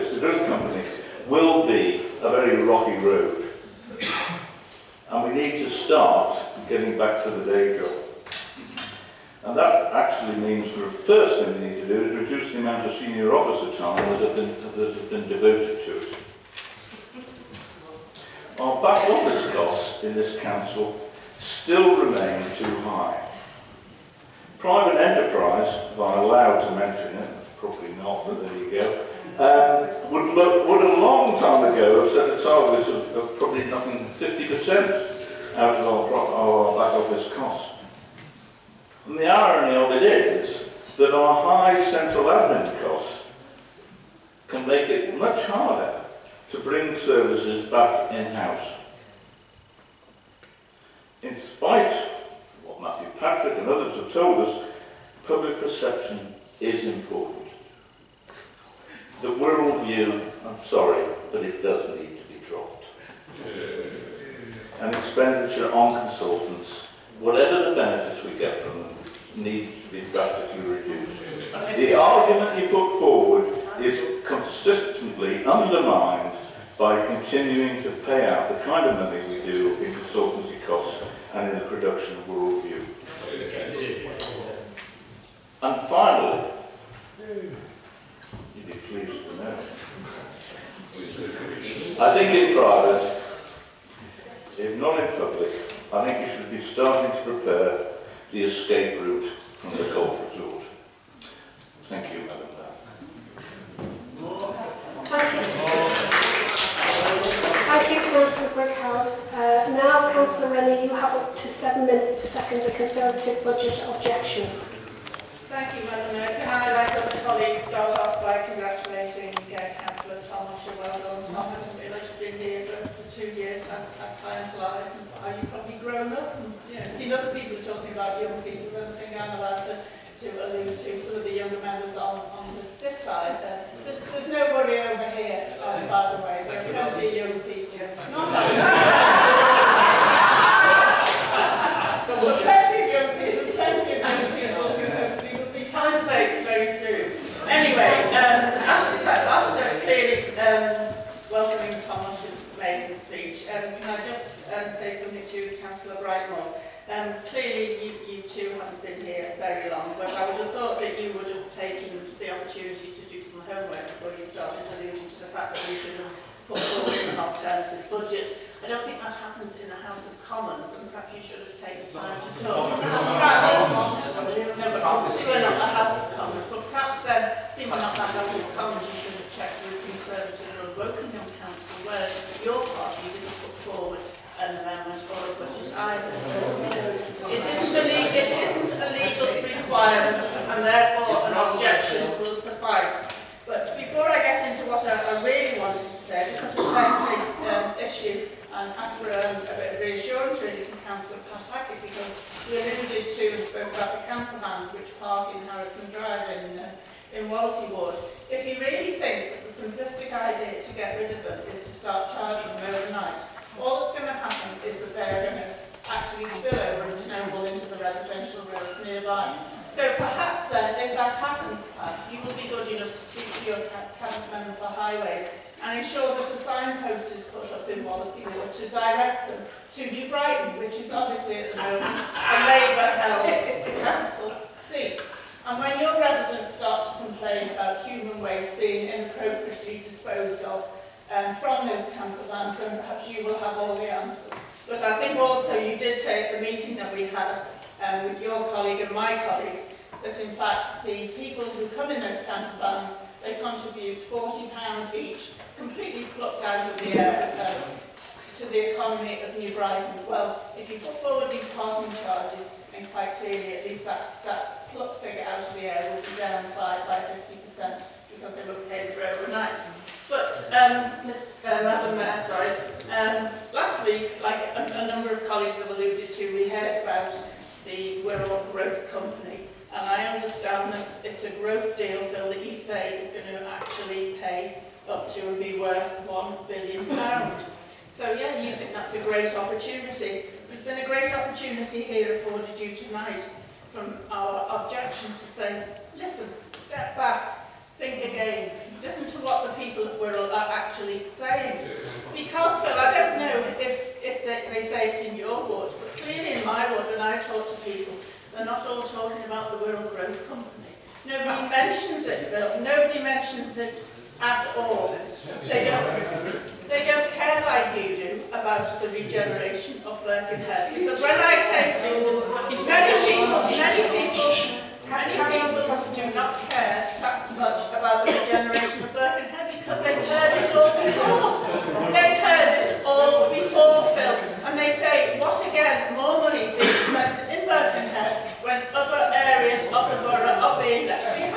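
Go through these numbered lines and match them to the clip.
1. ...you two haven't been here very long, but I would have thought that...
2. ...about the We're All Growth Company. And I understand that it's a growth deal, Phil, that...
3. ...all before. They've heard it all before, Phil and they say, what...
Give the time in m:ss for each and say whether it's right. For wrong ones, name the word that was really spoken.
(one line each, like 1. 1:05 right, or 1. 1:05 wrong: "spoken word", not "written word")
1. 2:38 right
2. 4:36 right
3. 5:30 right.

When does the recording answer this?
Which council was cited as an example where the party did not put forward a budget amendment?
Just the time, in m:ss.
3:00.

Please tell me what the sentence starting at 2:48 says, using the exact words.
I don't think that happens in the House of Commons, and perhaps you should have taken time to talk.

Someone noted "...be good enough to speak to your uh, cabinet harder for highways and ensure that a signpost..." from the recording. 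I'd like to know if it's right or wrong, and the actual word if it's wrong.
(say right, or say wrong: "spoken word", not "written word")
wrong: "member", not "harder".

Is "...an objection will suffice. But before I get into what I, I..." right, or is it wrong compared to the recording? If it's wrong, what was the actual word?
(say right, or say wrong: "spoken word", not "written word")
right.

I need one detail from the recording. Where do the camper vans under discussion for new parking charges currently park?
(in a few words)
Harrison Drive.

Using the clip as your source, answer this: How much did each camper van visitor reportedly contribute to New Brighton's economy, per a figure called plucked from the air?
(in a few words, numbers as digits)
£40.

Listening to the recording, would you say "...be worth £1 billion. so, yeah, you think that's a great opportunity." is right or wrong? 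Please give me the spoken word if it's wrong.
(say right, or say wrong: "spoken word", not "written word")
right.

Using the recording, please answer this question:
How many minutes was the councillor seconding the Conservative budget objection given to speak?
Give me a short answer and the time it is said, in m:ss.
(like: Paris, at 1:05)
7, at 1:51.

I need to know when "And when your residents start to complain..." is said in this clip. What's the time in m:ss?
3:55.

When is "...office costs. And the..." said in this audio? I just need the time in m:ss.
0:37.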